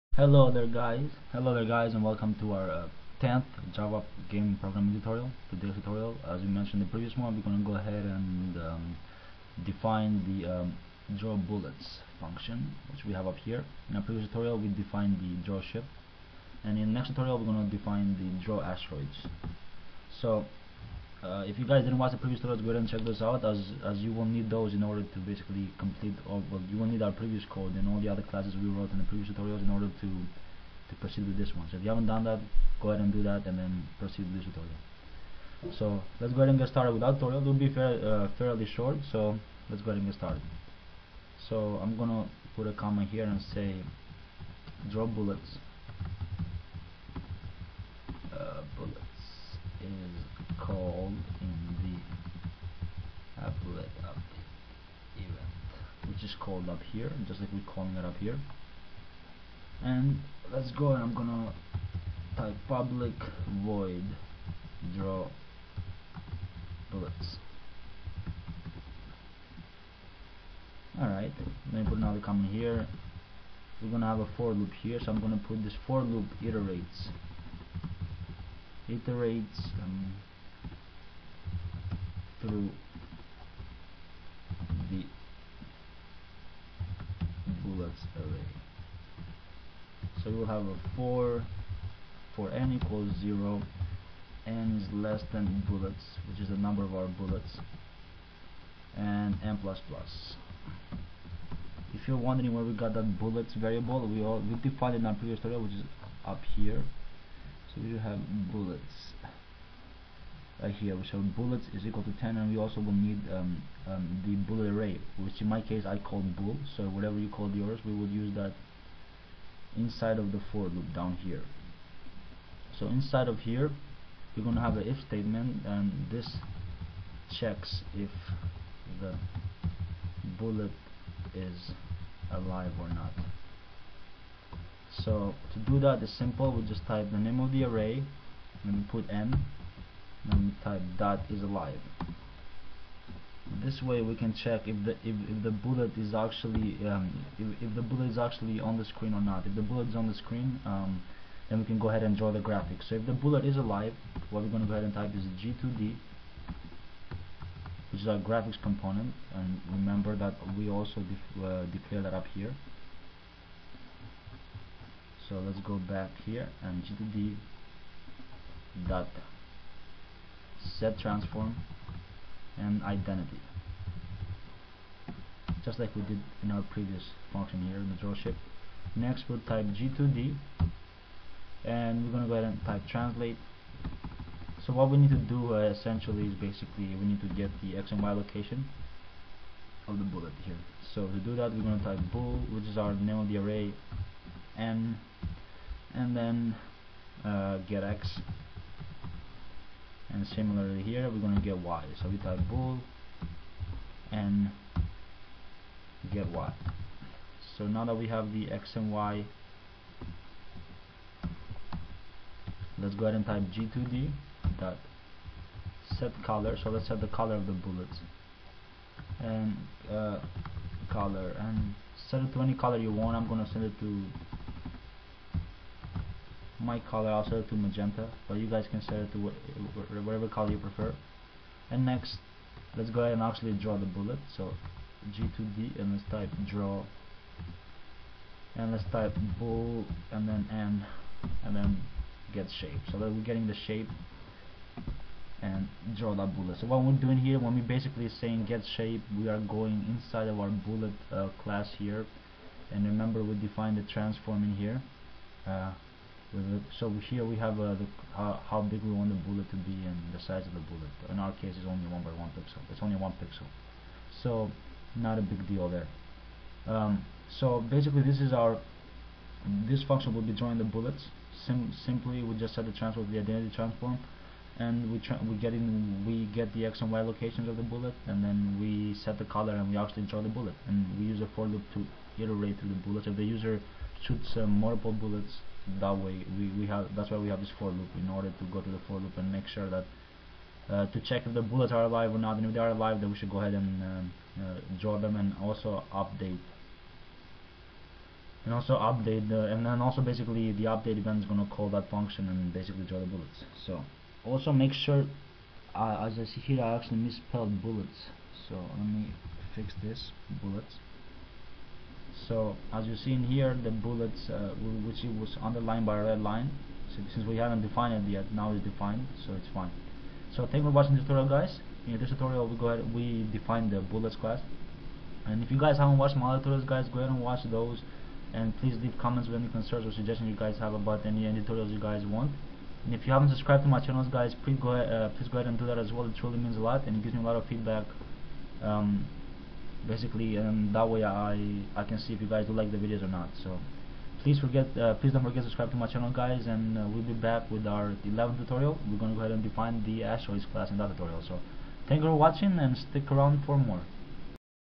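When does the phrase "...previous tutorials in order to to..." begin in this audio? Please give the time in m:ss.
0:29.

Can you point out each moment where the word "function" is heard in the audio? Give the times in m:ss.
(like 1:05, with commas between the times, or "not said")
0:12, 2:57, 4:29, 5:01.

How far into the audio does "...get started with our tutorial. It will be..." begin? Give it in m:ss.
0:36.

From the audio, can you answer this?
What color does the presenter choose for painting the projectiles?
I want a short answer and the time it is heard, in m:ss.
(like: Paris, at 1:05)
magenta, at 3:47.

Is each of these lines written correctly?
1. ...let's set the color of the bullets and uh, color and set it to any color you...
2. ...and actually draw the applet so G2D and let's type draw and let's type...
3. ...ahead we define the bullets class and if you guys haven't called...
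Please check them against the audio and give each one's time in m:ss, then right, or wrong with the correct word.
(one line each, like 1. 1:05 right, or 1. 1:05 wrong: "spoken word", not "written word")
1. 3:36 right
2. 3:53 wrong: "bullet", not "applet"
3. 5:22 wrong: "watched", not "called".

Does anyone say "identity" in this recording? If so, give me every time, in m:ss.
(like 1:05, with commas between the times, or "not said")
2:52, 4:33.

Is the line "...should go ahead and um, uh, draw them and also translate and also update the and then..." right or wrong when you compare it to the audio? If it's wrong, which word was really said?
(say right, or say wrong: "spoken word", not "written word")
wrong: "update", not "translate".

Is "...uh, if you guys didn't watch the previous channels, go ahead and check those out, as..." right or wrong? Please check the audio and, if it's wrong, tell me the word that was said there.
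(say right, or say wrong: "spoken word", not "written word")
wrong: "tutorials", not "channels".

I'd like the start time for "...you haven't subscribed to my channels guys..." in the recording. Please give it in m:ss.
5:33.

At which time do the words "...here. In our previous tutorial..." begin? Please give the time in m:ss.
0:13.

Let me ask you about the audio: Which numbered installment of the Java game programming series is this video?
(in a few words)
10th.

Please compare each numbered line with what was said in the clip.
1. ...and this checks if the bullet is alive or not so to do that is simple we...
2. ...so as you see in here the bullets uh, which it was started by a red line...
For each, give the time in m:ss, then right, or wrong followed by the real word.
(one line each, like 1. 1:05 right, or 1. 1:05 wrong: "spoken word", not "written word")
1. 2:05 right
2. 5:12 wrong: "underlined", not "started".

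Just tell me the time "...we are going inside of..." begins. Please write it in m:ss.
4:09.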